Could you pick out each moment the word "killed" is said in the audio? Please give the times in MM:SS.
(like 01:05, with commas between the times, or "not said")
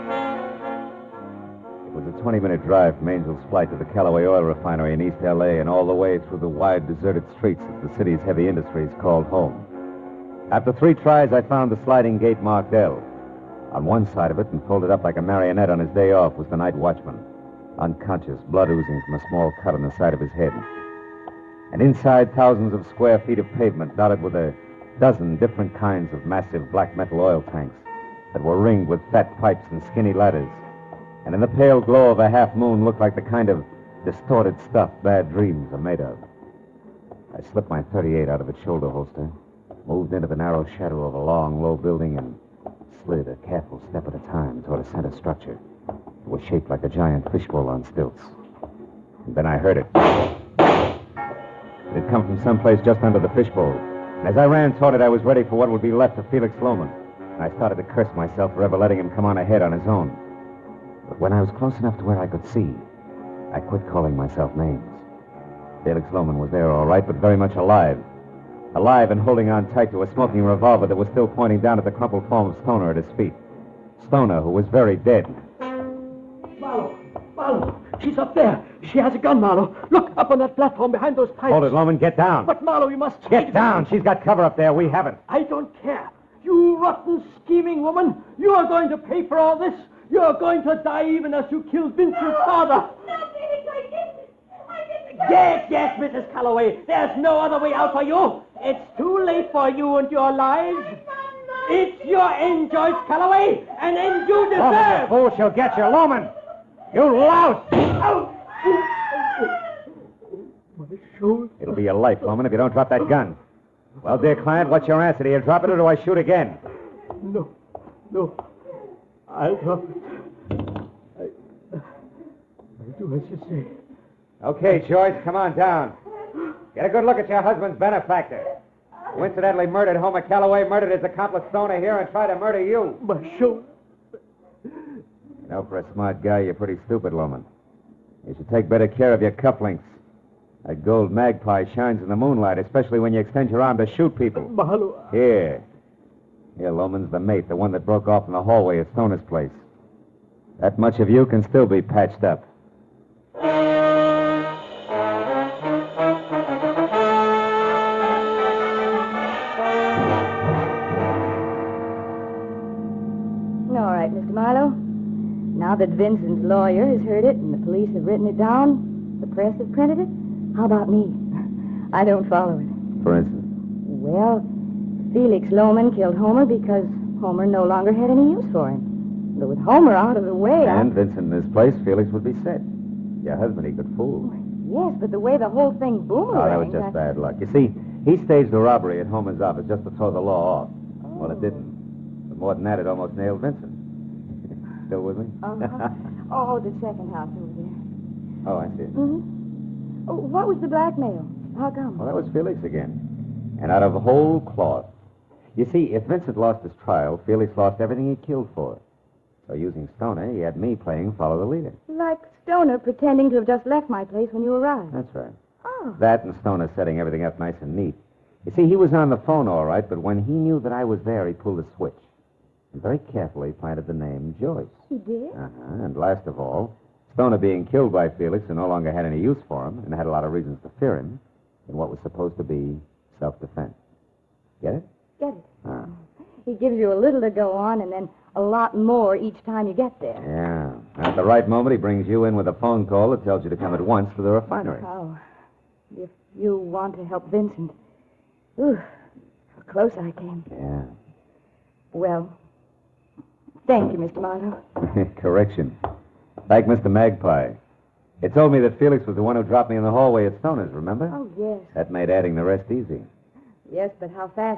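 01:31, 02:55, 03:28, 03:47.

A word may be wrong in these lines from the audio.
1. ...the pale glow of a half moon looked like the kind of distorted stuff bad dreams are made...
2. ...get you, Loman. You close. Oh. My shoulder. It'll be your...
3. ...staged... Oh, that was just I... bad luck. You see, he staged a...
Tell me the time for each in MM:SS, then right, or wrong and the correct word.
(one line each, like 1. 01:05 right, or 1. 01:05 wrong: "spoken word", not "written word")
1. 00:31 right
2. 01:45 wrong: "louse", not "close"
3. 03:05 wrong: "boomeranged", not "staged".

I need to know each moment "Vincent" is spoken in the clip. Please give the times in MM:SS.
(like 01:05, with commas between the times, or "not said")
01:31, 03:00, 03:13, 03:26, 04:07.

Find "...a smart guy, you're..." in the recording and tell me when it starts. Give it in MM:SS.
02:15.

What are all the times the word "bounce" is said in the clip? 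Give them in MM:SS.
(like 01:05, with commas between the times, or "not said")
not said.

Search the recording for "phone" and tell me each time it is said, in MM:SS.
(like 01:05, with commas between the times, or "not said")
03:39, 04:02.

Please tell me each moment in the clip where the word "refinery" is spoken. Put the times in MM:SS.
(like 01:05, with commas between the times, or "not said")
00:04, 04:04.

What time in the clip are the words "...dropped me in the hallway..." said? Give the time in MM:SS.
04:19.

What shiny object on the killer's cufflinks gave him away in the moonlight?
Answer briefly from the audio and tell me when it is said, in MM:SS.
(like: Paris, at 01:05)
Gold magpie, at 02:20.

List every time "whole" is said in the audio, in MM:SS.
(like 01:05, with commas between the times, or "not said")
03:05, 03:24.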